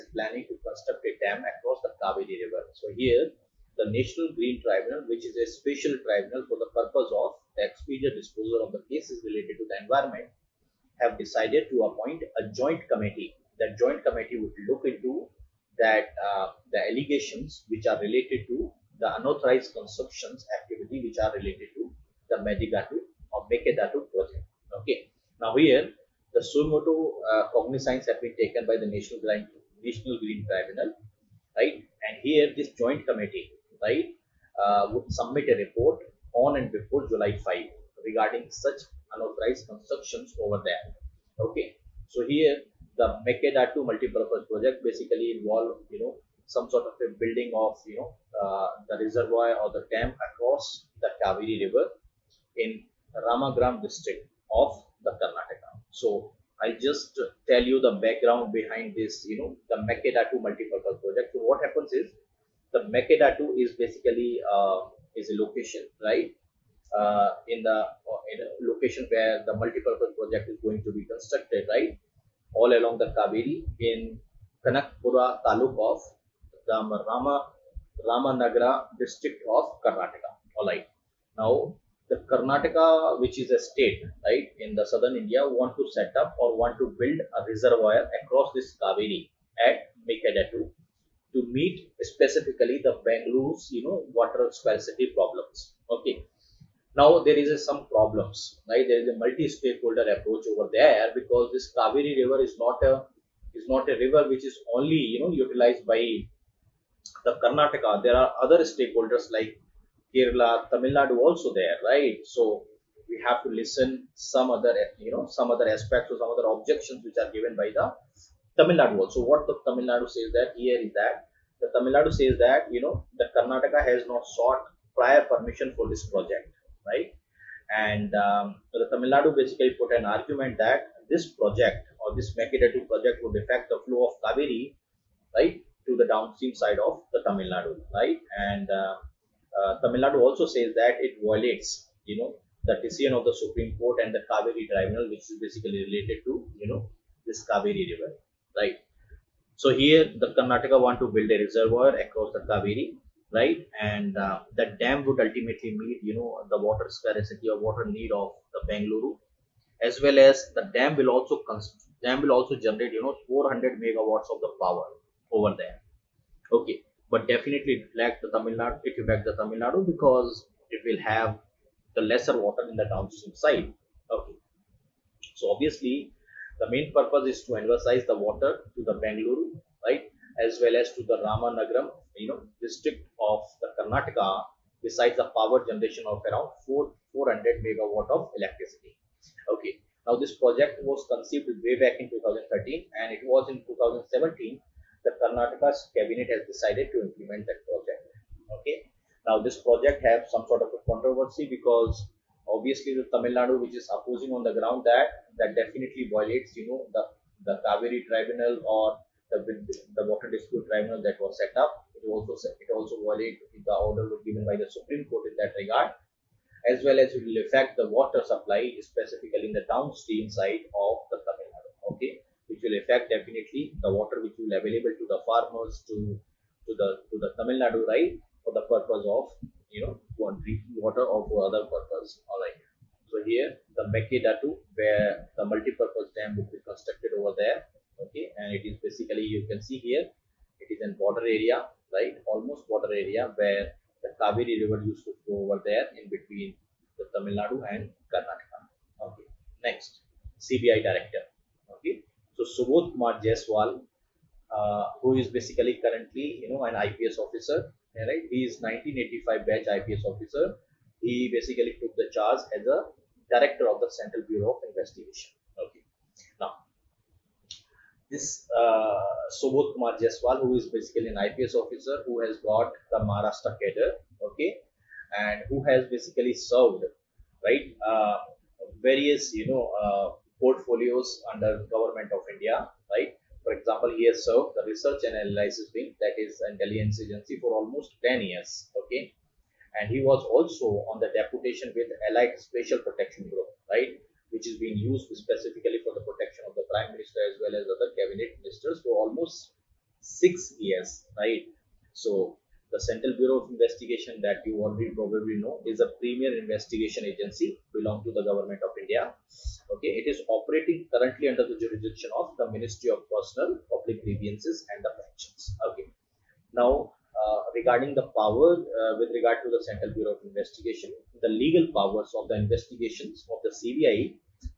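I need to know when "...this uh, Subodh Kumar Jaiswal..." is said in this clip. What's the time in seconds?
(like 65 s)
268 s.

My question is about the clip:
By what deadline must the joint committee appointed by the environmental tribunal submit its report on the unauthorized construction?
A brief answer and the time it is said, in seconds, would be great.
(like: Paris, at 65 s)
July 5, at 37 s.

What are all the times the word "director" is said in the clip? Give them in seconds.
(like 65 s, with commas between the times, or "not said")
250 s, 263 s.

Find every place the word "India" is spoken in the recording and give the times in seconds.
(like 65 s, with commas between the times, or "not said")
85 s, 282 s, 308 s.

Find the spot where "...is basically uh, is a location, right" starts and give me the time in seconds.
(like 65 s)
63 s.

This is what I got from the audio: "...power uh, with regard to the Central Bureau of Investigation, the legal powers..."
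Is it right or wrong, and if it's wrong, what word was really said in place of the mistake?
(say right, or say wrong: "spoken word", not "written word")
right.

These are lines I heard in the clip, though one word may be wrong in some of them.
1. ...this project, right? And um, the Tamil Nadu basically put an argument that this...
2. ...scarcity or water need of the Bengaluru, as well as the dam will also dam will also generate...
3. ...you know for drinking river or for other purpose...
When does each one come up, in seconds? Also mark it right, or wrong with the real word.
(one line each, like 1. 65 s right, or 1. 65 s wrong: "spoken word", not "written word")
1. 125 s right
2. 156 s right
3. 229 s wrong: "water", not "river".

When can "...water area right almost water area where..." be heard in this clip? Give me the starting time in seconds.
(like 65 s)
241 s.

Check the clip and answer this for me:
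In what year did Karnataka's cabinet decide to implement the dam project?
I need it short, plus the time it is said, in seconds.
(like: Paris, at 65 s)
2017, at 193 s.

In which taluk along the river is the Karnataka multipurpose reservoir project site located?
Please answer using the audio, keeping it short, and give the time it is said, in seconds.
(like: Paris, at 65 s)
Kanakpura, at 74 s.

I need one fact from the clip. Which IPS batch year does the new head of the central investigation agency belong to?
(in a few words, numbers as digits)
1985.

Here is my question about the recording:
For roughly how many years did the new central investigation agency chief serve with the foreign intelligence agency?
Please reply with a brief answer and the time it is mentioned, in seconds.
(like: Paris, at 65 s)
10 years, at 288 s.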